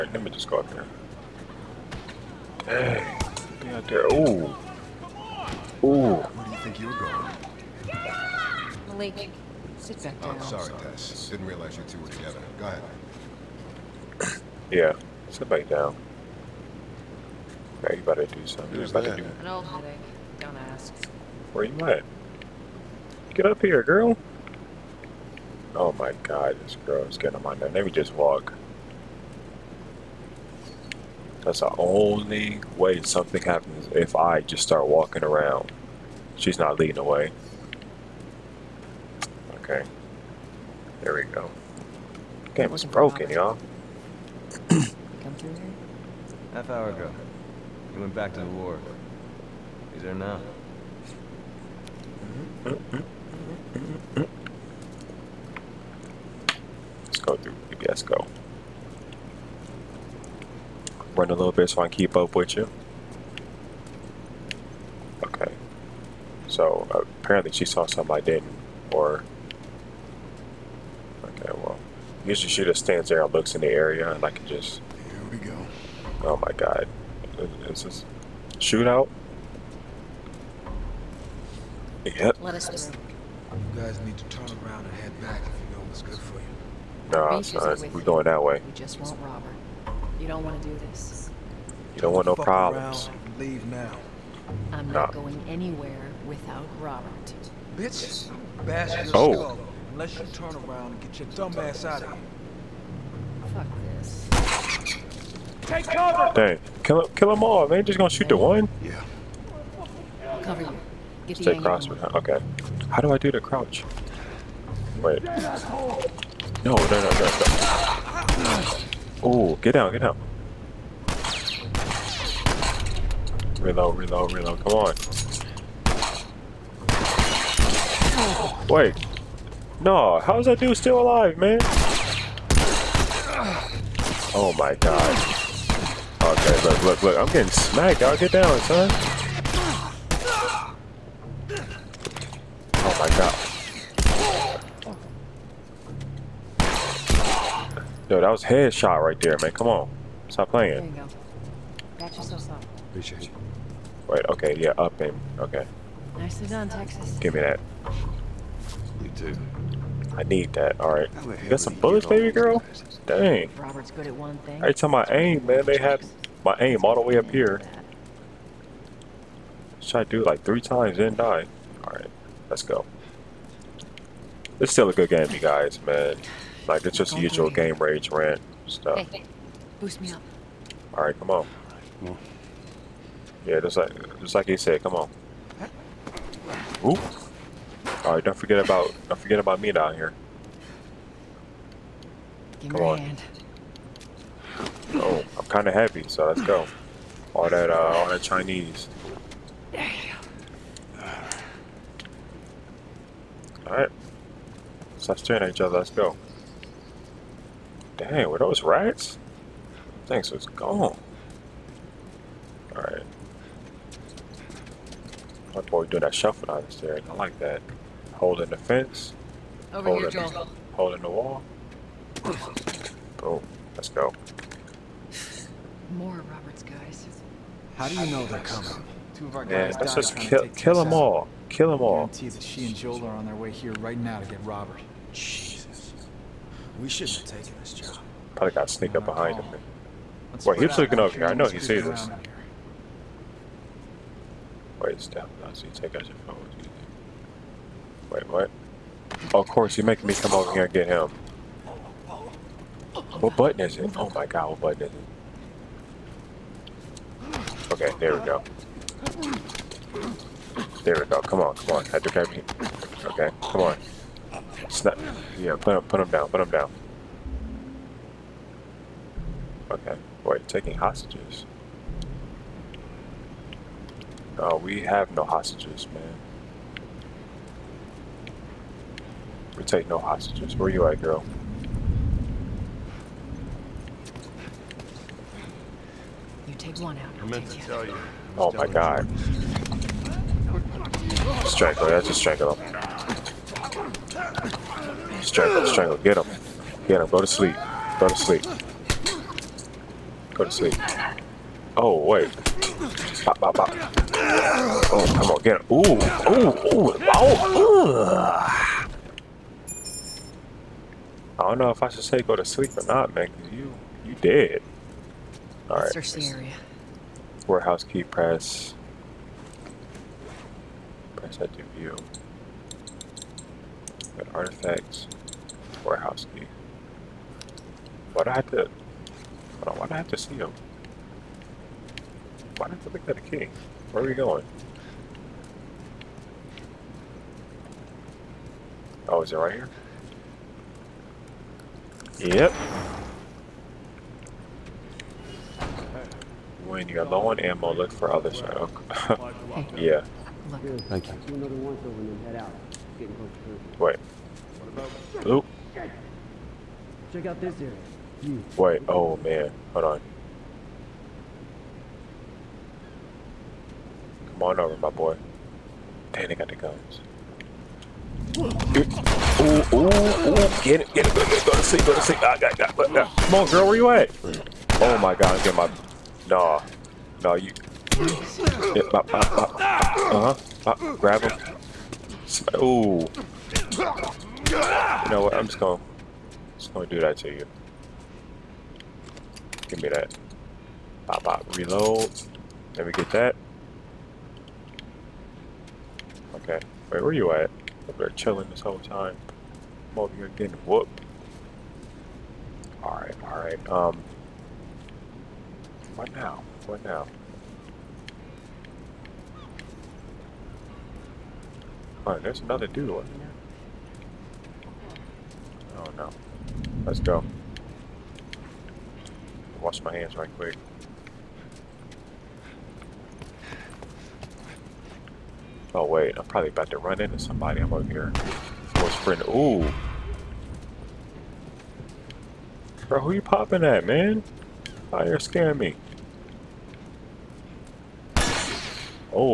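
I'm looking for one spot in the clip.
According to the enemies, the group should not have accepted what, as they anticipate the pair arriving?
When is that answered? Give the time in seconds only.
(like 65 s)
236 s.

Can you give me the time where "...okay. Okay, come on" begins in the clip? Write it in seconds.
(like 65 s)
262 s.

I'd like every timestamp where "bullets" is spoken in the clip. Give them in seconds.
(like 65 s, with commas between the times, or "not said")
161 s.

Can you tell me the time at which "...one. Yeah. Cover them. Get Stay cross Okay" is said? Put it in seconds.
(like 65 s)
108 s.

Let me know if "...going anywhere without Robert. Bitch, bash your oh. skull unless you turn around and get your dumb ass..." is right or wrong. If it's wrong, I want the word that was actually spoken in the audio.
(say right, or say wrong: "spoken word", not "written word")
right.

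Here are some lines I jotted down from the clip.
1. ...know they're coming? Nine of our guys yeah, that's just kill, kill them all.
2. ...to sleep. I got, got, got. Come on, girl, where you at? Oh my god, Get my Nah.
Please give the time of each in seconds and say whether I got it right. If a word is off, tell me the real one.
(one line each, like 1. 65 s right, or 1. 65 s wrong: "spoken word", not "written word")
1. 228 s wrong: "Two", not "Nine"
2. 371 s right.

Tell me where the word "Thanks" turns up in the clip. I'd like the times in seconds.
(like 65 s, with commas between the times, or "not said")
210 s, 350 s.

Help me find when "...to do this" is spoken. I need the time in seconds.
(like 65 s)
90 s.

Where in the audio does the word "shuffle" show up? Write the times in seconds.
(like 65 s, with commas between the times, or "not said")
216 s.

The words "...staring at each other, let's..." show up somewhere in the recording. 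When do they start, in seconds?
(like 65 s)
205 s.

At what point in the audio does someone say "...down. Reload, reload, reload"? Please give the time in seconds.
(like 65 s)
120 s.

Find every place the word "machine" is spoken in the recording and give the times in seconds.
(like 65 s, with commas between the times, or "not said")
not said.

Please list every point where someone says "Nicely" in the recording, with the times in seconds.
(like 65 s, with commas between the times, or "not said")
156 s.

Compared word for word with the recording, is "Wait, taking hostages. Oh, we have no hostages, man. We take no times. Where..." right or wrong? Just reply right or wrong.
wrong.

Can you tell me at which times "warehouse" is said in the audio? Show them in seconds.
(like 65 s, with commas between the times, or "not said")
317 s, 325 s.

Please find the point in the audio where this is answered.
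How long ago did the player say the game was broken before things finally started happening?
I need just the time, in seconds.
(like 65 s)
46 s.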